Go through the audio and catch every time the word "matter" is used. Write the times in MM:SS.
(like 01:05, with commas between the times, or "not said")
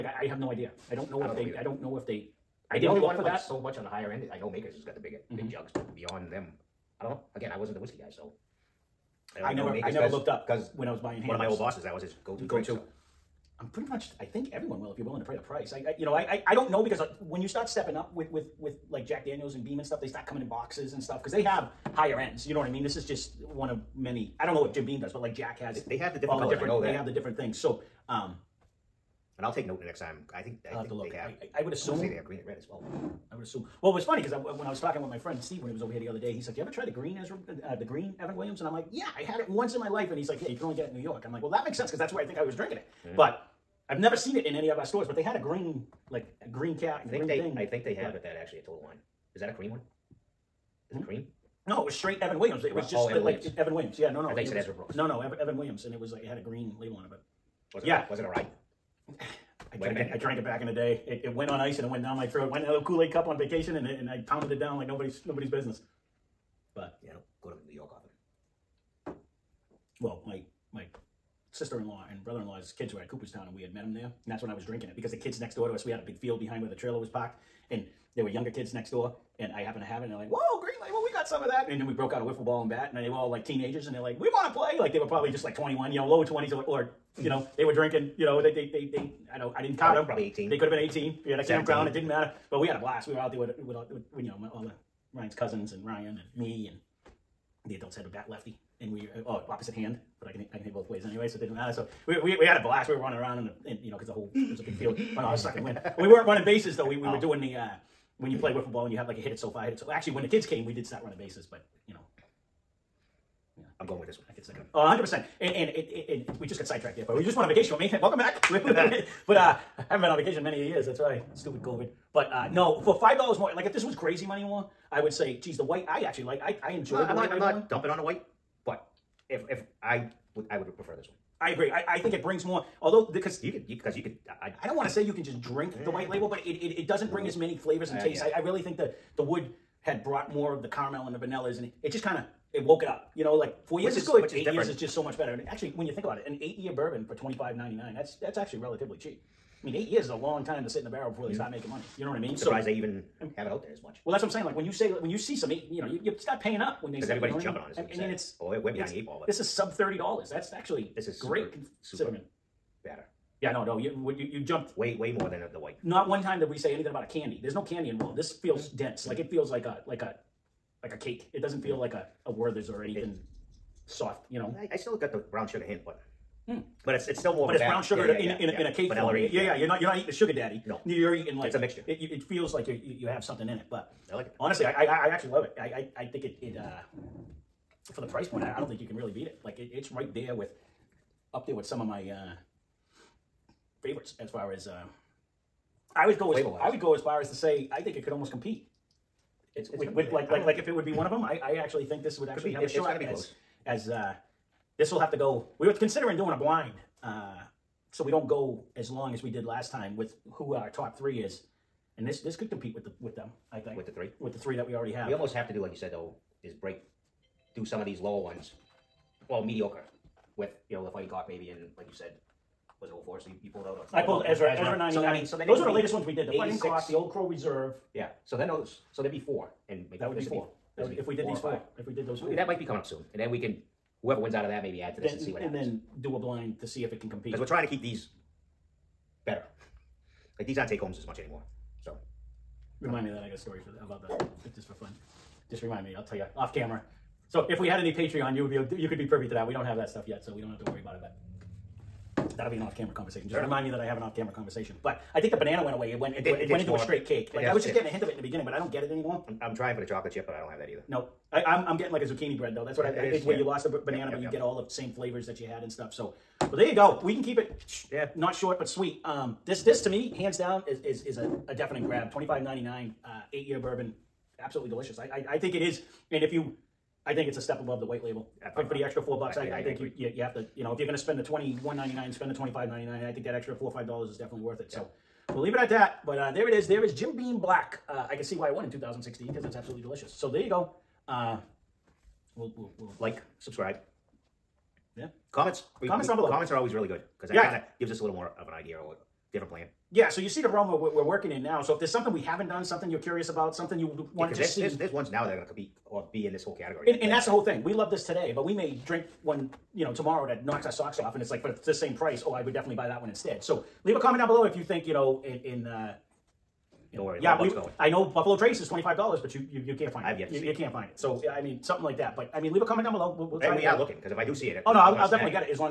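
01:32, 01:41.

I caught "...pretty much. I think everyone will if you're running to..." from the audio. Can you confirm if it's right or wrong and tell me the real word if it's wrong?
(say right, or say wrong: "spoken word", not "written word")
wrong: "willing", not "running".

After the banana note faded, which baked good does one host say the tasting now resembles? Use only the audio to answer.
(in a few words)
zucchini bread.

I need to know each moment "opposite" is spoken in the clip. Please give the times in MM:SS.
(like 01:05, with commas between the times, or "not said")
01:39.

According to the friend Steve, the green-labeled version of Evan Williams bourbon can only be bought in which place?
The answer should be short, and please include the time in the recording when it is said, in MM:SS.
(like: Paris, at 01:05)
New York, at 00:40.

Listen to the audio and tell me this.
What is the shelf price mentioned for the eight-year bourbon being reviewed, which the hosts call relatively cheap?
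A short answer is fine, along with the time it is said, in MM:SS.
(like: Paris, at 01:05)
$25.99, at 02:27.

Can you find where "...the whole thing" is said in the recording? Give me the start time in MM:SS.
05:07.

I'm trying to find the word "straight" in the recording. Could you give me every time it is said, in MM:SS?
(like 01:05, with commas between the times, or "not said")
00:51, 04:16.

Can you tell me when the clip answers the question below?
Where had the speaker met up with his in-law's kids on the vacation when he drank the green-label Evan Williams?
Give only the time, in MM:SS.
01:13.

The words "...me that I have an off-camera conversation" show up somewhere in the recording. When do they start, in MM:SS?
04:13.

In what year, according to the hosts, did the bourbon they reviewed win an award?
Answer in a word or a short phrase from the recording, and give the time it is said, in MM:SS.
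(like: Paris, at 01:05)
2016, at 04:48.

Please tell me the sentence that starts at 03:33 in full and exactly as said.
I think with the three with the three that we already have.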